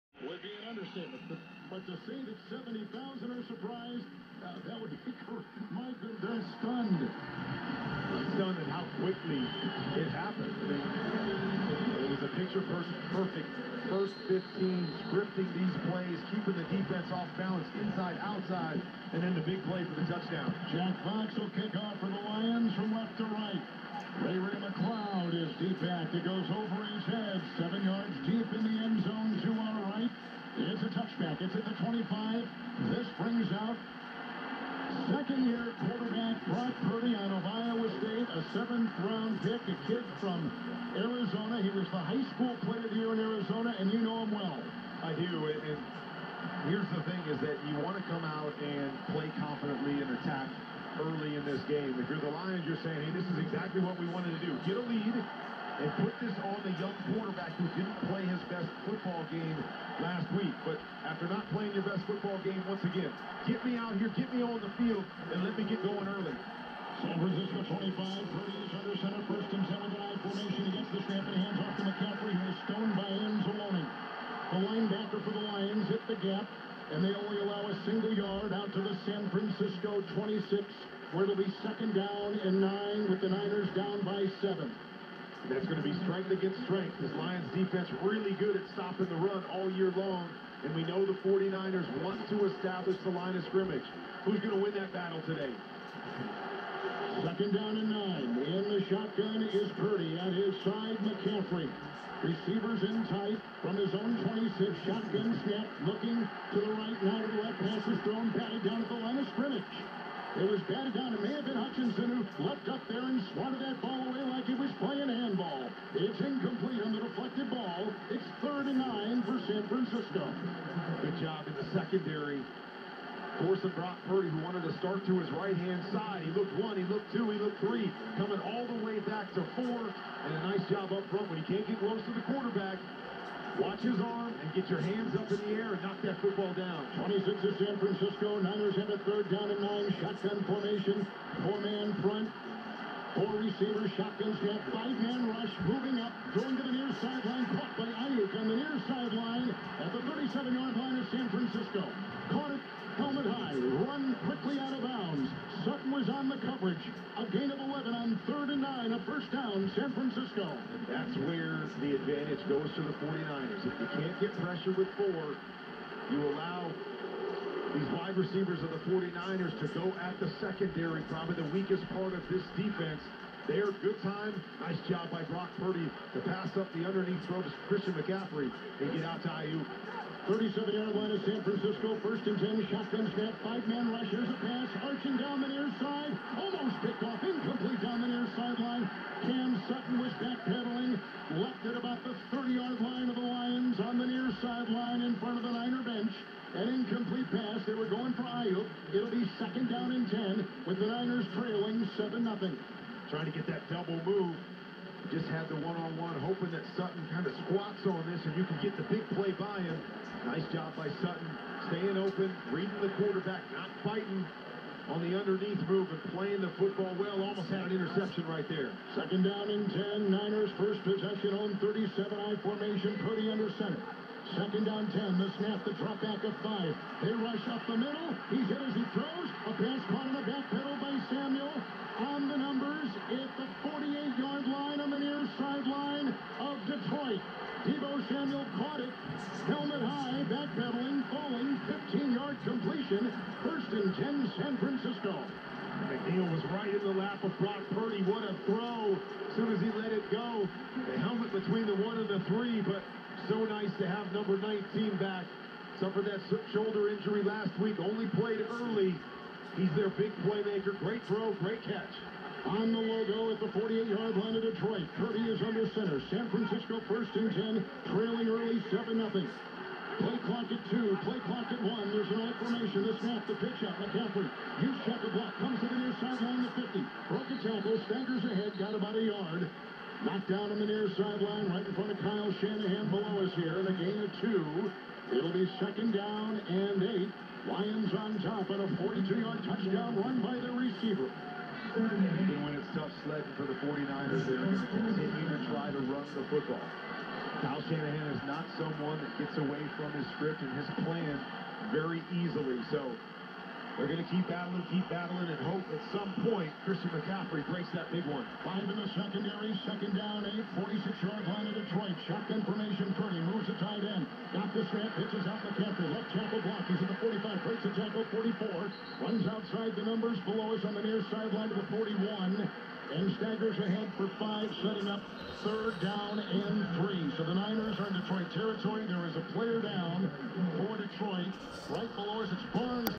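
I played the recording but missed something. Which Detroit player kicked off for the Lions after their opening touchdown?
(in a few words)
Jack Fox.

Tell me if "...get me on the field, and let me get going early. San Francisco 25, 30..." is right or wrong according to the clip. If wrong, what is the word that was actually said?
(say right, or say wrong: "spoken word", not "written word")
right.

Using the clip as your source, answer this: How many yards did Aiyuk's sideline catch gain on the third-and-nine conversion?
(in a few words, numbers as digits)
11.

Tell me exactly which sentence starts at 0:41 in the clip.
He was the high school player of the year in Arizona, and you know him well.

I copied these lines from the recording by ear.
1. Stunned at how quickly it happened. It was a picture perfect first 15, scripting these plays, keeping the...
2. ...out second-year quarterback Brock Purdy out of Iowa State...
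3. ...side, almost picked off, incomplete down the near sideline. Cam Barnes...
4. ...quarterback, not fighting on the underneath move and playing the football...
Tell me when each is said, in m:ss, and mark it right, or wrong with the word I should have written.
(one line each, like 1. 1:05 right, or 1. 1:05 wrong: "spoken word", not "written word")
1. 0:07 right
2. 0:33 right
3. 3:05 wrong: "Sutton", not "Barnes"
4. 3:33 right.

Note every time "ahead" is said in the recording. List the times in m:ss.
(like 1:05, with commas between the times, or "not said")
4:38, 5:23.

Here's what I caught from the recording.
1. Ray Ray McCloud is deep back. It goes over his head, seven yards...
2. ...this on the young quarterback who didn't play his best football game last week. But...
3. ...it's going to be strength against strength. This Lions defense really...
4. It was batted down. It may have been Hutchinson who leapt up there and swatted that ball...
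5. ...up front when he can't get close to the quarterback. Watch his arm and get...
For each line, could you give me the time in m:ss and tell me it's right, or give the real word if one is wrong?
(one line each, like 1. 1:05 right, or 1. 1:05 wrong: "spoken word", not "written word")
1. 0:24 right
2. 0:56 right
3. 1:25 right
4. 1:50 right
5. 2:10 right.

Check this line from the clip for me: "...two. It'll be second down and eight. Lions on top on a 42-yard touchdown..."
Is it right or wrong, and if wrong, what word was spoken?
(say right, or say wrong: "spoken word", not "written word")
right.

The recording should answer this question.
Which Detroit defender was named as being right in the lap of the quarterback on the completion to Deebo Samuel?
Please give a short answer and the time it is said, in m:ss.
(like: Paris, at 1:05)
McNeill, at 4:05.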